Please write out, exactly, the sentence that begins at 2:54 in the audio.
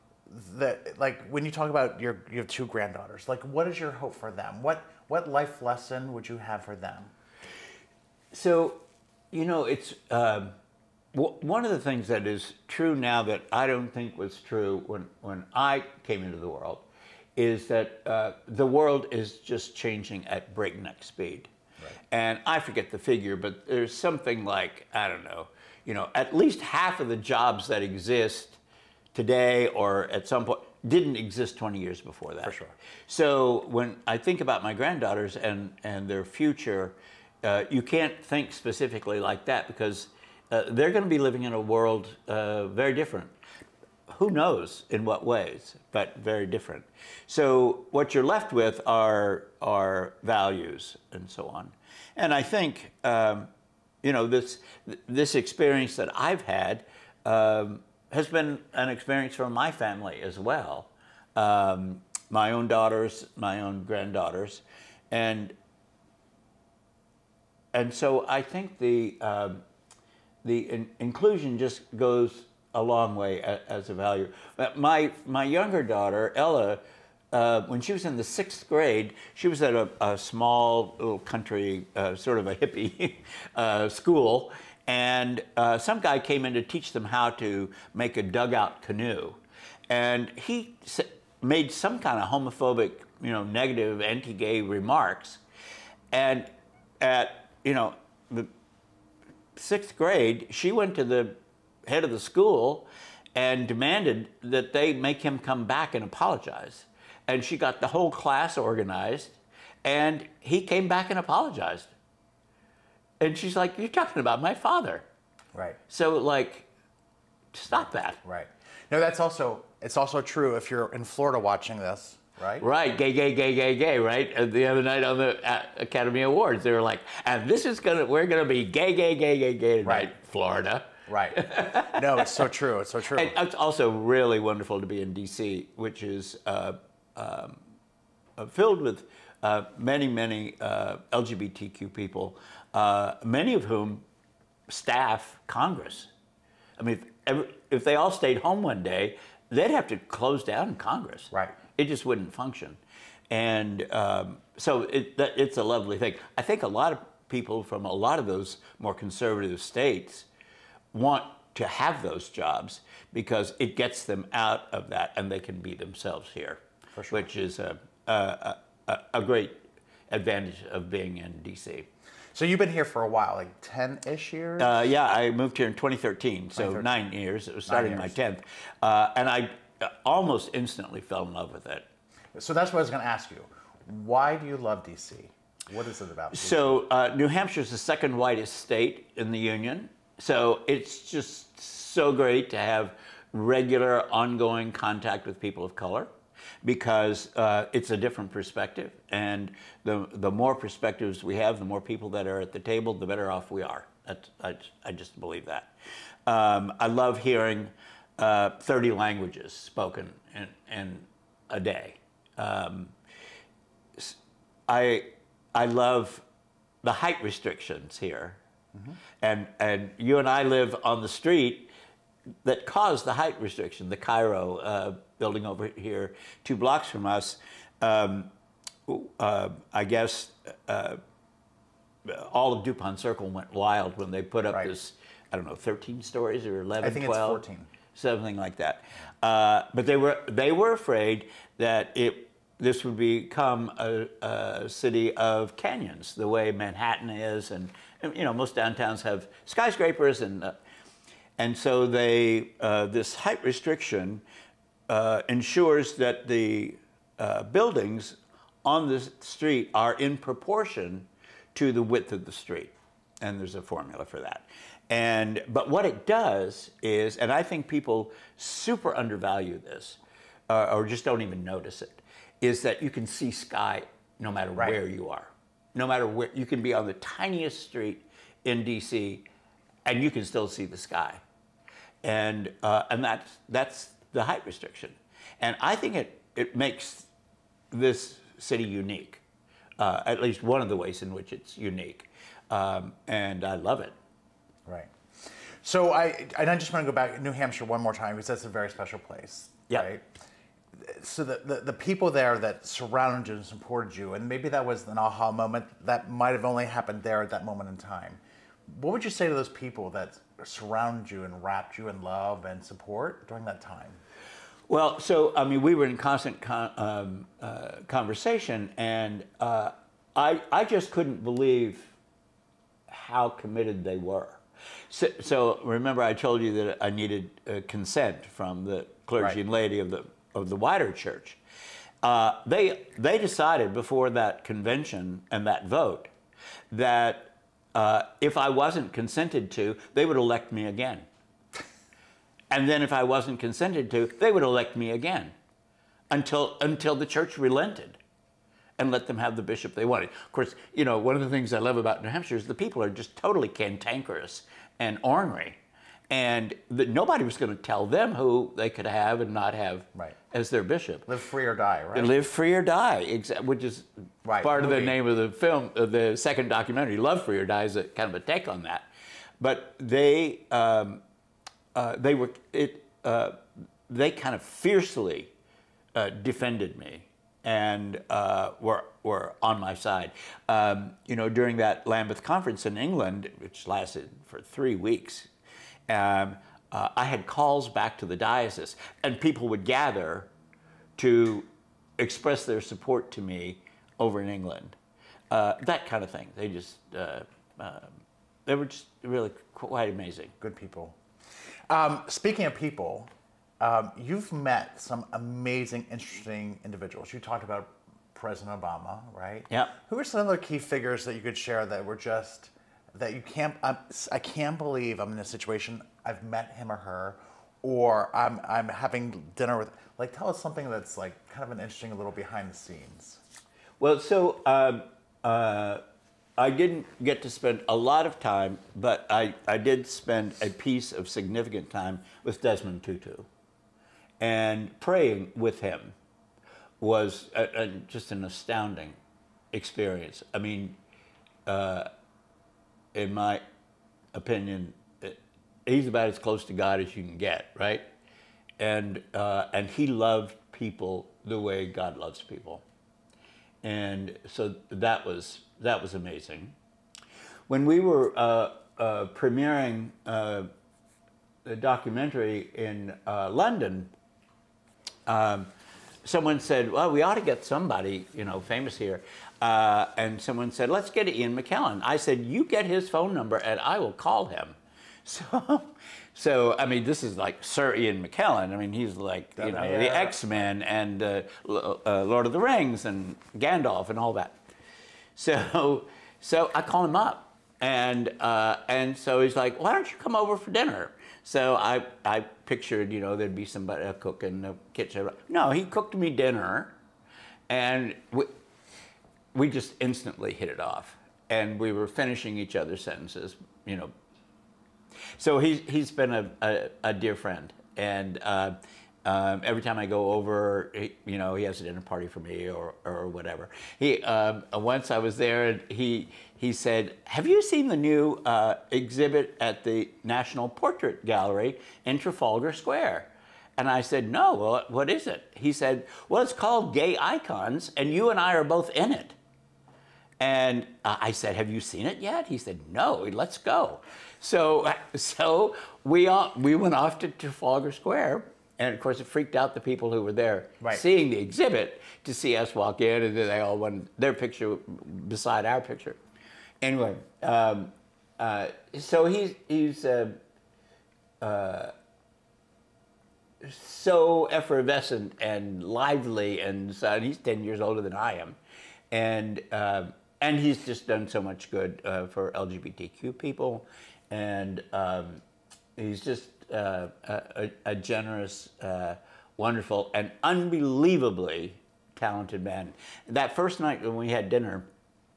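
Uh, yeah, I moved here in 2013, so 2013.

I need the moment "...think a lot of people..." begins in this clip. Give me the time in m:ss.
2:36.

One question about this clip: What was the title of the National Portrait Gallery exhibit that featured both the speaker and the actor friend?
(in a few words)
Gay Icons.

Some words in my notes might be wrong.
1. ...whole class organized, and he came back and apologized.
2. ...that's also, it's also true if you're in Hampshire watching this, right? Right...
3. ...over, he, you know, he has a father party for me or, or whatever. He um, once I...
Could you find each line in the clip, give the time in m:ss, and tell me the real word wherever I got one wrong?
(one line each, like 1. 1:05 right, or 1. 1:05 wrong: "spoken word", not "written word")
1. 1:47 right
2. 1:58 wrong: "Florida", not "Hampshire"
3. 8:30 wrong: "dinner", not "father".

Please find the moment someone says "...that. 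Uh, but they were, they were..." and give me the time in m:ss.
3:58.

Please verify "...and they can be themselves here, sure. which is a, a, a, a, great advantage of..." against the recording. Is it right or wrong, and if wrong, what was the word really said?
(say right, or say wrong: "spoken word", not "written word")
right.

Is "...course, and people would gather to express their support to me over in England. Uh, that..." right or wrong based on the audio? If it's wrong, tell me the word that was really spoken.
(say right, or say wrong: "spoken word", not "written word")
wrong: "diocese", not "course".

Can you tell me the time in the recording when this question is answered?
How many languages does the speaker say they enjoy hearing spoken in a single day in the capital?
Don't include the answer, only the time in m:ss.
3:28.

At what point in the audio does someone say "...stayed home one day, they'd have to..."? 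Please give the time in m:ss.
2:28.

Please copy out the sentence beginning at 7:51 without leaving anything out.
I said, you get his phone number and I will call him.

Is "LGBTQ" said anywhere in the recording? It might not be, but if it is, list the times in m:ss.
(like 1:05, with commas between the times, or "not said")
2:21, 9:22.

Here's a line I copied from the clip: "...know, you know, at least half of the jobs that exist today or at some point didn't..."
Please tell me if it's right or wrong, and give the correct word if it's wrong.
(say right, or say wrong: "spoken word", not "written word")
right.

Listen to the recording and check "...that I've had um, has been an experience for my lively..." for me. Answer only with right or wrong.
wrong.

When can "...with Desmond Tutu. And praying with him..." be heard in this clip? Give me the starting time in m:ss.
7:12.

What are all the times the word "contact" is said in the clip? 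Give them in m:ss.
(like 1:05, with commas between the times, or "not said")
3:14.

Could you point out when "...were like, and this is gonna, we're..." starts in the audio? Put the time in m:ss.
2:06.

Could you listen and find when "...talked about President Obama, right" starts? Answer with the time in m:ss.
6:47.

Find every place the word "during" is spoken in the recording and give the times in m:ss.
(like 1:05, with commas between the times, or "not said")
5:13, 6:21.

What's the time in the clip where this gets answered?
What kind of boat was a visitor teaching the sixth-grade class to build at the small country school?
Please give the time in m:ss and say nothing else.
1:28.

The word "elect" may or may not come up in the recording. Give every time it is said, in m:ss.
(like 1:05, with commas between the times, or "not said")
5:40, 5:44.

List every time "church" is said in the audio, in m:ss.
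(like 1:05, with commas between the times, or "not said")
5:30, 5:47.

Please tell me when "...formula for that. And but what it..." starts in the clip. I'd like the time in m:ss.
4:23.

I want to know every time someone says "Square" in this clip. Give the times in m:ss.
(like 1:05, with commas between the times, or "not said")
8:42, 8:57.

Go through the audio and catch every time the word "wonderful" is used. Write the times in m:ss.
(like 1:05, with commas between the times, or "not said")
2:14, 9:29.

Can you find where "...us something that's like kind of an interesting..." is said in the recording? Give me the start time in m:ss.
7:00.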